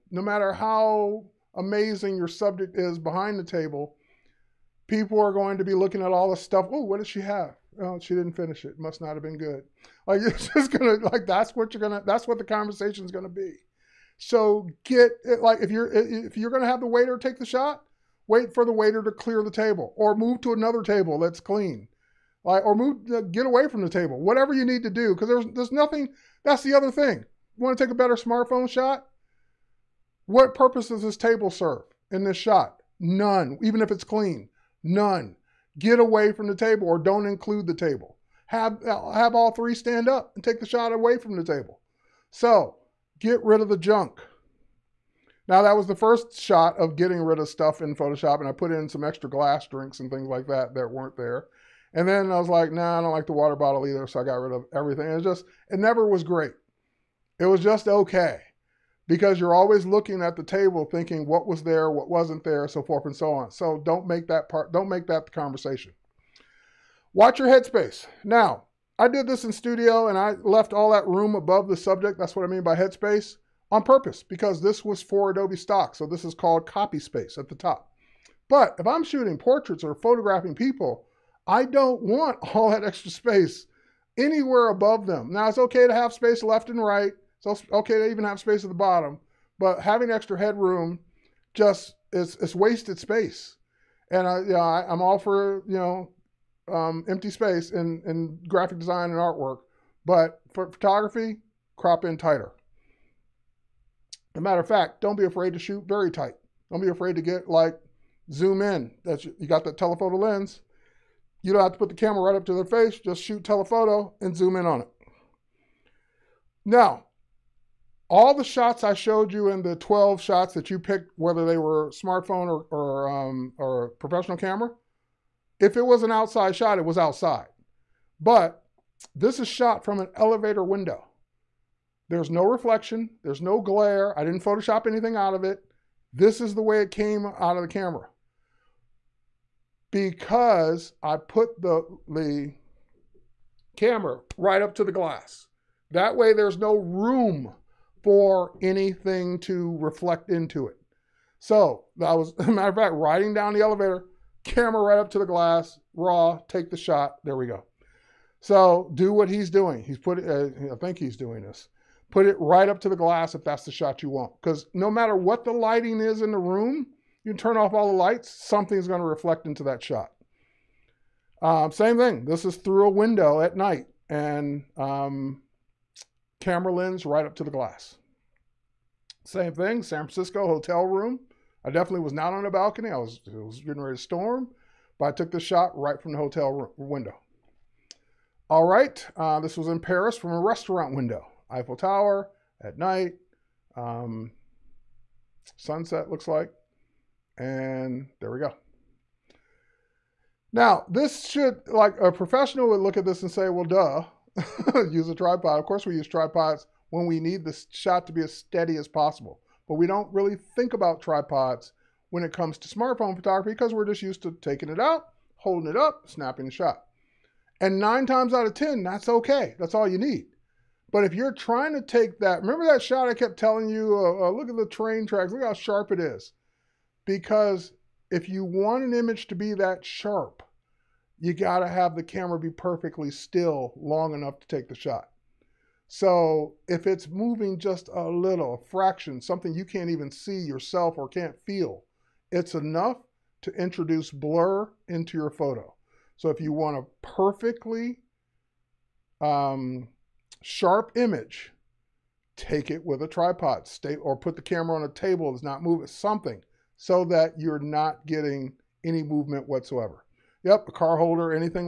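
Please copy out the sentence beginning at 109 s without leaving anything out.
That's you got that telephoto lens.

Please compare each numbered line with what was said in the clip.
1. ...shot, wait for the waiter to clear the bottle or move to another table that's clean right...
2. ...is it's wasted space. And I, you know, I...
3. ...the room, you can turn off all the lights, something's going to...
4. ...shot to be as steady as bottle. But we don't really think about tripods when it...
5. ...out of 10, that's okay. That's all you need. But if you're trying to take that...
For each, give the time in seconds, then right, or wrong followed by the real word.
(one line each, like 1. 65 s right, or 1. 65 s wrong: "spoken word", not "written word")
1. 17 s wrong: "table", not "bottle"
2. 92 s right
3. 166 s right
4. 207 s wrong: "possible", not "bottle"
5. 218 s right.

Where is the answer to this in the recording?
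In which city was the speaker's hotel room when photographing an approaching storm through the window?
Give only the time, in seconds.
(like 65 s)
179 s.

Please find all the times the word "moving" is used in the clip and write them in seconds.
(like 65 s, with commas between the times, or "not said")
237 s, 255 s.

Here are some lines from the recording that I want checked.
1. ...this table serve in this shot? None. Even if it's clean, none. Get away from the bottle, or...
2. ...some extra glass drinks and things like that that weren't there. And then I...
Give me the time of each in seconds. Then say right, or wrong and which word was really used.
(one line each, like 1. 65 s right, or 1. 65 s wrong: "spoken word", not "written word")
1. 31 s wrong: "table", not "bottle"
2. 48 s right.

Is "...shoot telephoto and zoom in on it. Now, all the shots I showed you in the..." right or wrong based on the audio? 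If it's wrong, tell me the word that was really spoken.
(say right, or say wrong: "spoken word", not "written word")
right.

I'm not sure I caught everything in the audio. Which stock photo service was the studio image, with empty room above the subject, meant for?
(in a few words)
Adobe Stock.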